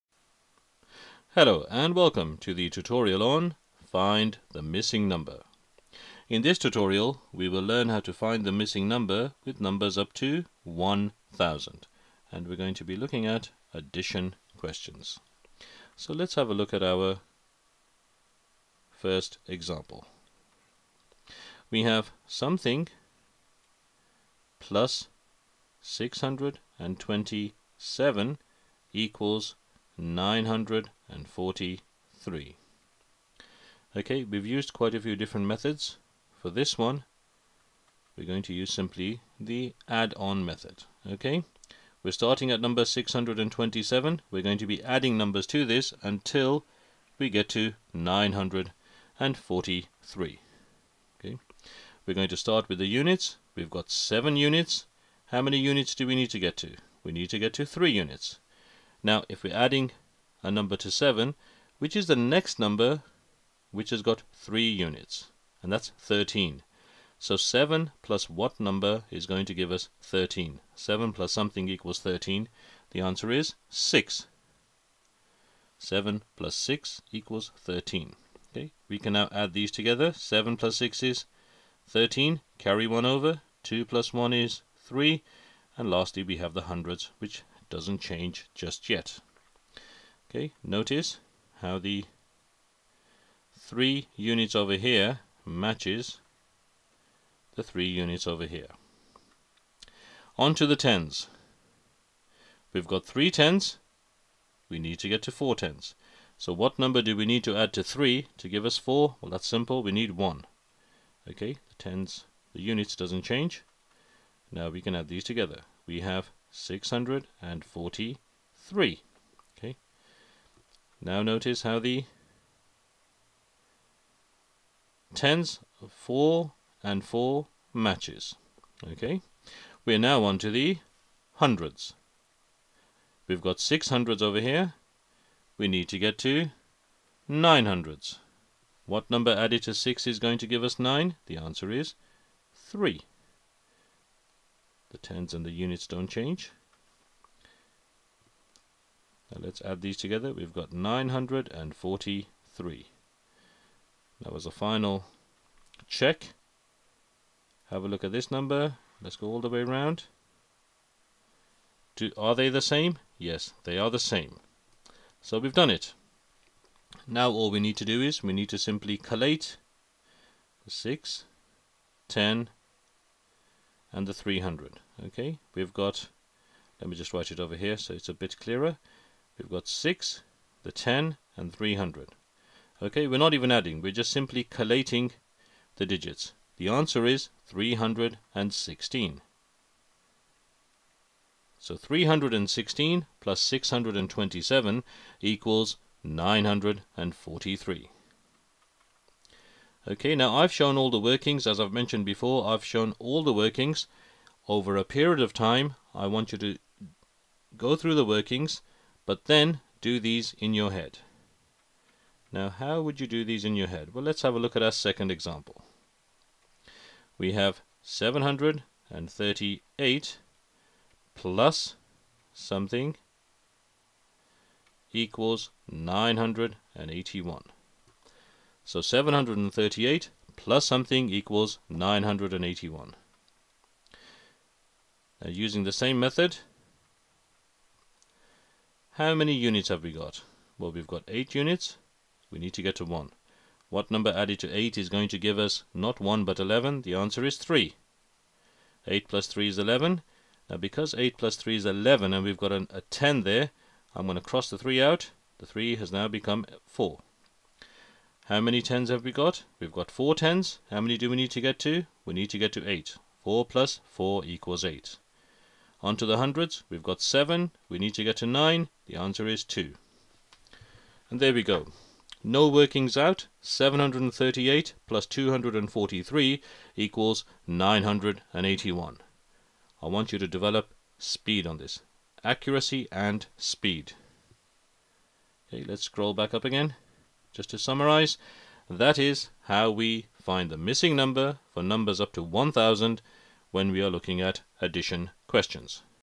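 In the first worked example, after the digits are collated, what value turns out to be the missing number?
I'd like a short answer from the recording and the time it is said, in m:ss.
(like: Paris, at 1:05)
316, at 3:06.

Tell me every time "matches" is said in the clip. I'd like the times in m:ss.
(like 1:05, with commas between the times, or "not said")
1:35, 2:07.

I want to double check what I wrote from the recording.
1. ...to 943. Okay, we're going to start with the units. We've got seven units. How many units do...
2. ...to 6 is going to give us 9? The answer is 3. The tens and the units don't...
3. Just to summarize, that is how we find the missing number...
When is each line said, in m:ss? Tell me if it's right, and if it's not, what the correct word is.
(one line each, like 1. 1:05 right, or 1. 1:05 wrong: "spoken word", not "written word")
1. 0:47 right
2. 2:19 right
3. 4:47 right.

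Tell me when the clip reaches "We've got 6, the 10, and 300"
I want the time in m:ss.
2:59.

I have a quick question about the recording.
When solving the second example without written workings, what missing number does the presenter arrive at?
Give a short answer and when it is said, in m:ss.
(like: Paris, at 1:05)
243, at 4:35.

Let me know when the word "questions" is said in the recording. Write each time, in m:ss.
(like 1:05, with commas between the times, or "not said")
0:14, 4:55.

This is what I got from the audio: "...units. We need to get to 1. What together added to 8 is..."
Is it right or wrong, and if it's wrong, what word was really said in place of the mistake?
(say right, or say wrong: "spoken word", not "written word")
wrong: "number", not "together".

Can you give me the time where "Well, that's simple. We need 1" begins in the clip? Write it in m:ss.
1:49.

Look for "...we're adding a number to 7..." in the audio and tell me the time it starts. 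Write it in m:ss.
0:59.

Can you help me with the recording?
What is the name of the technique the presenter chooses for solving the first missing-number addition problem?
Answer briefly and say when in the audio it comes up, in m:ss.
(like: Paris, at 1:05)
add-on method, at 0:39.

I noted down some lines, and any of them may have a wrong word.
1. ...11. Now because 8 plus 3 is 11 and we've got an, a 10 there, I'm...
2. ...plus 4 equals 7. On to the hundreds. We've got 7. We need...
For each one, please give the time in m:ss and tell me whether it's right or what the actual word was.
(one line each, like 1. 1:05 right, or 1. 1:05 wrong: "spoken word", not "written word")
1. 4:09 right
2. 4:23 wrong: "8", not "7".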